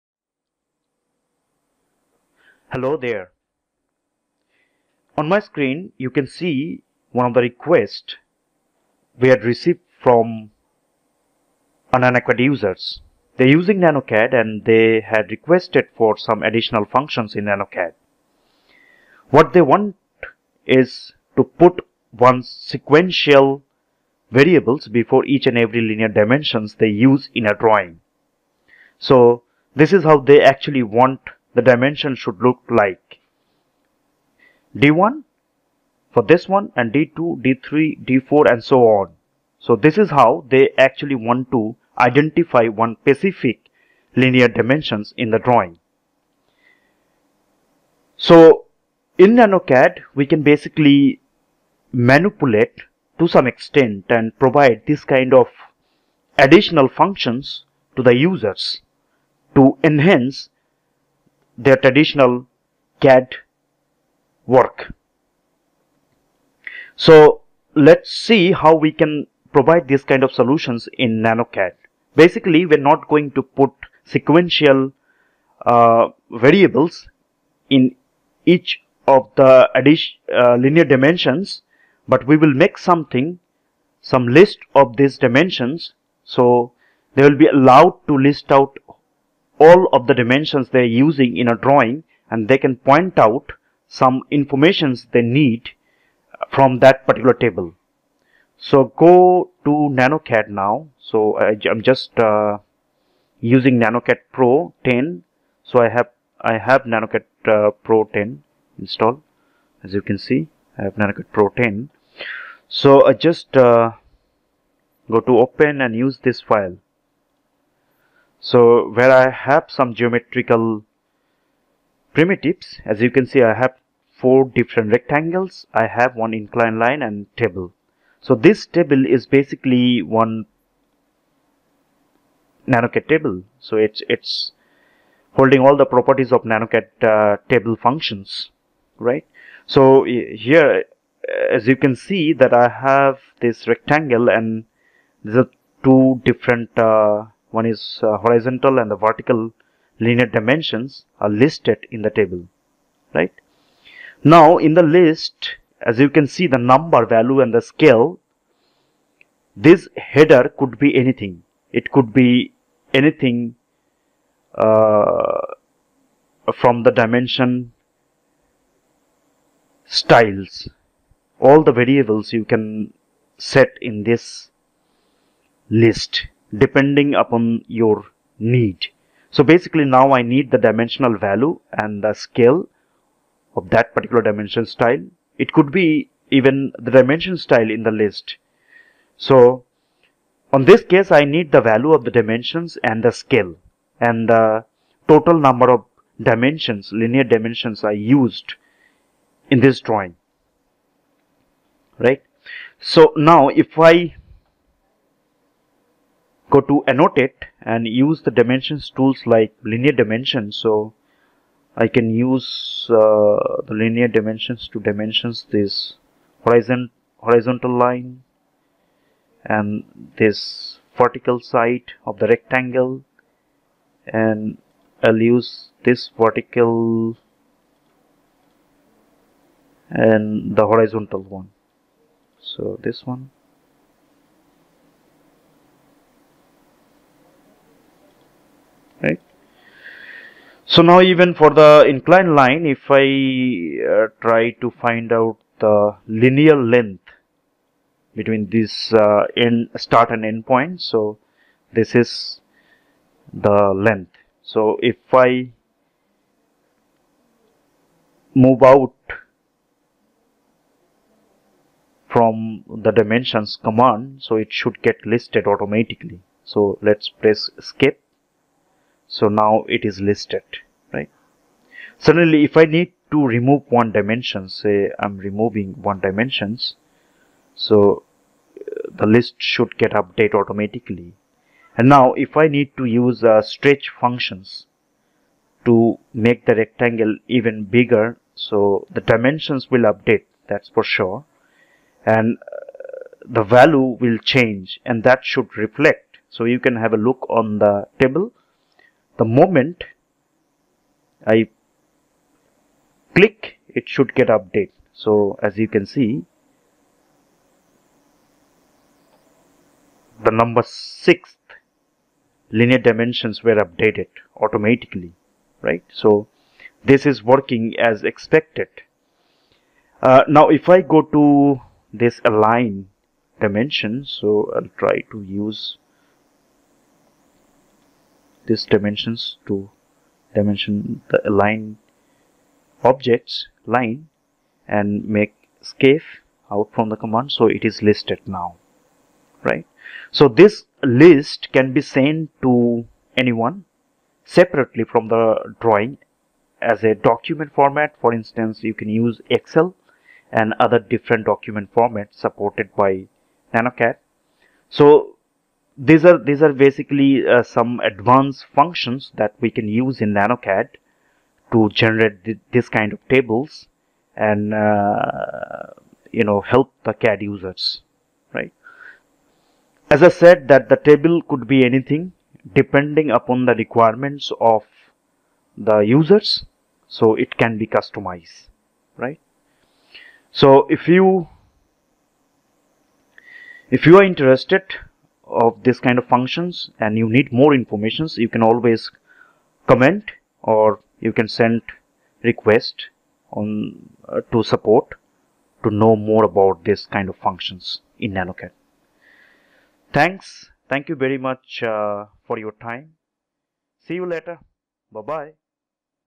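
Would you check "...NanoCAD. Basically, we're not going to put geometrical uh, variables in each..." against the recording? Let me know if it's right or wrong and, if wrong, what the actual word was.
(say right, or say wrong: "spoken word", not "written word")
wrong: "sequential", not "geometrical".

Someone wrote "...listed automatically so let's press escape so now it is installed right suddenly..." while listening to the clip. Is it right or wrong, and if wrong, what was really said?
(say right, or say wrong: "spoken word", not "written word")
wrong: "listed", not "installed".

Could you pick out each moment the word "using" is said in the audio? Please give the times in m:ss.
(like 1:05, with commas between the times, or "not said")
0:13, 1:31, 1:43.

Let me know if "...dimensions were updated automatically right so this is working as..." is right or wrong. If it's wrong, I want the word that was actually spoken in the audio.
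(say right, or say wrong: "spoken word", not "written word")
right.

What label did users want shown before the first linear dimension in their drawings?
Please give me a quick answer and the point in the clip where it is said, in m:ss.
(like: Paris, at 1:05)
d1, at 0:34.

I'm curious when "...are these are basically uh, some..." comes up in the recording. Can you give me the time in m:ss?
5:56.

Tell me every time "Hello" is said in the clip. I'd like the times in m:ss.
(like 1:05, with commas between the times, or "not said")
0:02.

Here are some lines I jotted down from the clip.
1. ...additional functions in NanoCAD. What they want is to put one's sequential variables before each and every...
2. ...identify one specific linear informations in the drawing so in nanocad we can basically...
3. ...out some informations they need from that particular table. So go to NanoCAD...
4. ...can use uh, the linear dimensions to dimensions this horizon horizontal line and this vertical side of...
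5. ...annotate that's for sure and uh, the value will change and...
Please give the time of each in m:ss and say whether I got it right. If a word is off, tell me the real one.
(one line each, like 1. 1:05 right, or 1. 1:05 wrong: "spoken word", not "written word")
1. 0:16 right
2. 0:41 wrong: "dimensions", not "informations"
3. 1:33 right
4. 3:31 right
5. 4:49 wrong: "update", not "annotate".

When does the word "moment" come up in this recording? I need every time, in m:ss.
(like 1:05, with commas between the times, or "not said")
4:59.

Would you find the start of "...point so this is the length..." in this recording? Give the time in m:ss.
4:10.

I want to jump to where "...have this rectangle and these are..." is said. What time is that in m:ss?
2:22.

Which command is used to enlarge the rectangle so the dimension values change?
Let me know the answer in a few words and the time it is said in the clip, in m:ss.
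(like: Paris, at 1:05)
stretch, at 4:43.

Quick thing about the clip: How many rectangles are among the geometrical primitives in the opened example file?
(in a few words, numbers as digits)
4.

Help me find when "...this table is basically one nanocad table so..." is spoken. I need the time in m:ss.
2:08.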